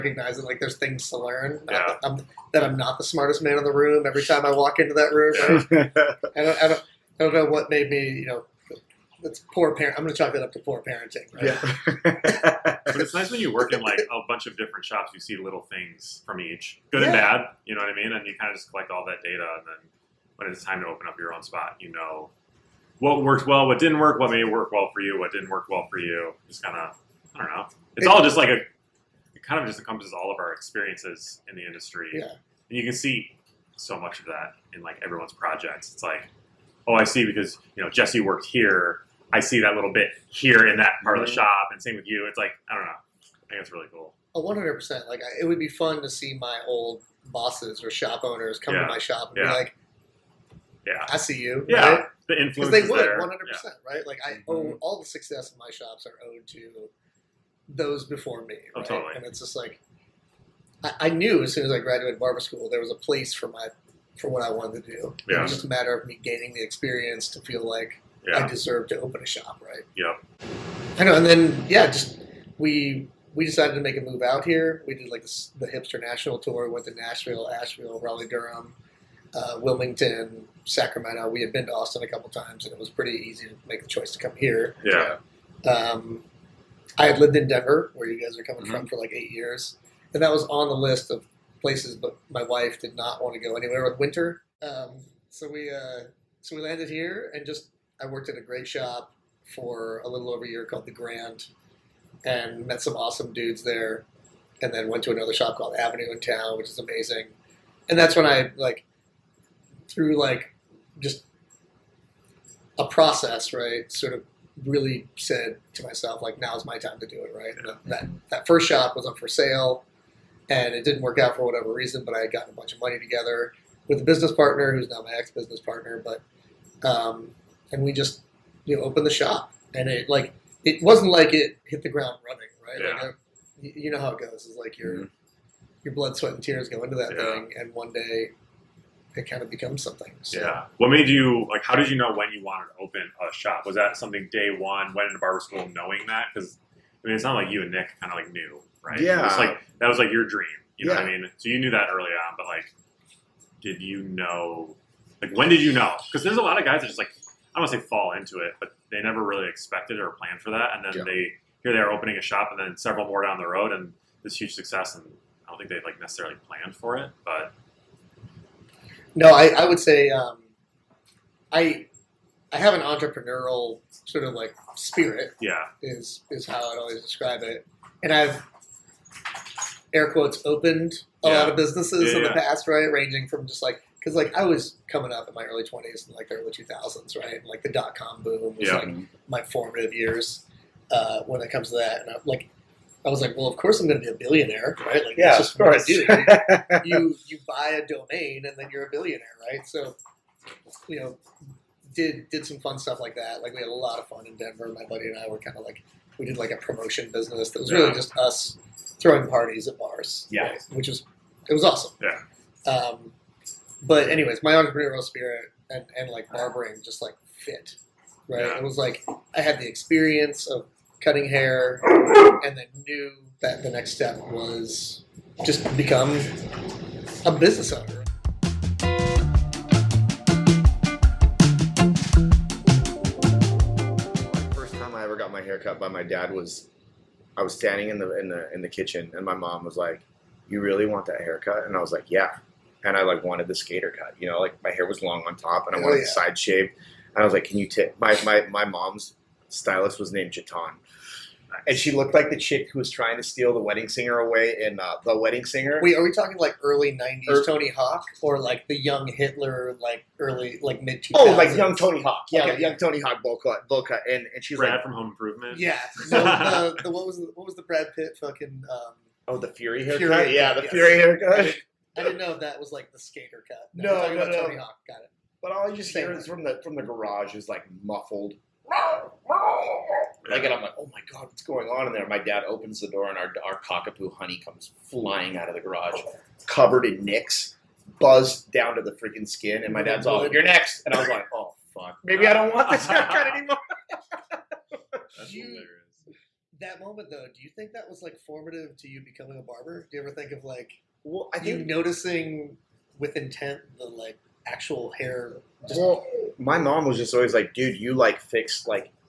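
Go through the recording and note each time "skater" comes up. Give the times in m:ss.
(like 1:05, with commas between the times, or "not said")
4:03, 4:32.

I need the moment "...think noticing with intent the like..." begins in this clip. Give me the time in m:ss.
5:01.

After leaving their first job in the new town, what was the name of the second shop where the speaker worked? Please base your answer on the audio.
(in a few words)
Avenue.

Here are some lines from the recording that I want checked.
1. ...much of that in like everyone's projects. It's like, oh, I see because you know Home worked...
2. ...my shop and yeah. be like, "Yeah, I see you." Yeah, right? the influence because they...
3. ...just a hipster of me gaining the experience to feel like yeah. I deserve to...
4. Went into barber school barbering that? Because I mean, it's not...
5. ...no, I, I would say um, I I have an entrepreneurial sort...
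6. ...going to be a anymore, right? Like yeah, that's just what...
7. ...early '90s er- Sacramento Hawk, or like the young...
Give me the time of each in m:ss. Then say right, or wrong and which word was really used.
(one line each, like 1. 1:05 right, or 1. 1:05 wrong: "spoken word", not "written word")
1. 0:33 wrong: "Jesse", not "Home"
2. 0:48 right
3. 1:05 wrong: "matter", not "hipster"
4. 2:24 wrong: "knowing", not "barbering"
5. 2:49 right
6. 3:13 wrong: "billionaire", not "anymore"
7. 4:16 wrong: "Tony", not "Sacramento".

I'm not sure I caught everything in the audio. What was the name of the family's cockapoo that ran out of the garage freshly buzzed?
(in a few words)
Honey.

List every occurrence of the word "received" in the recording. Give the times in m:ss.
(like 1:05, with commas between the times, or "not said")
not said.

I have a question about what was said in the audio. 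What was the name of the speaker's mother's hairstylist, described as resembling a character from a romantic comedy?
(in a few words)
Jaton.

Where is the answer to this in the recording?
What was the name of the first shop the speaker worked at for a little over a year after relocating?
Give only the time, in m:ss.
1:40.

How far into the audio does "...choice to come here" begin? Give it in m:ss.
1:23.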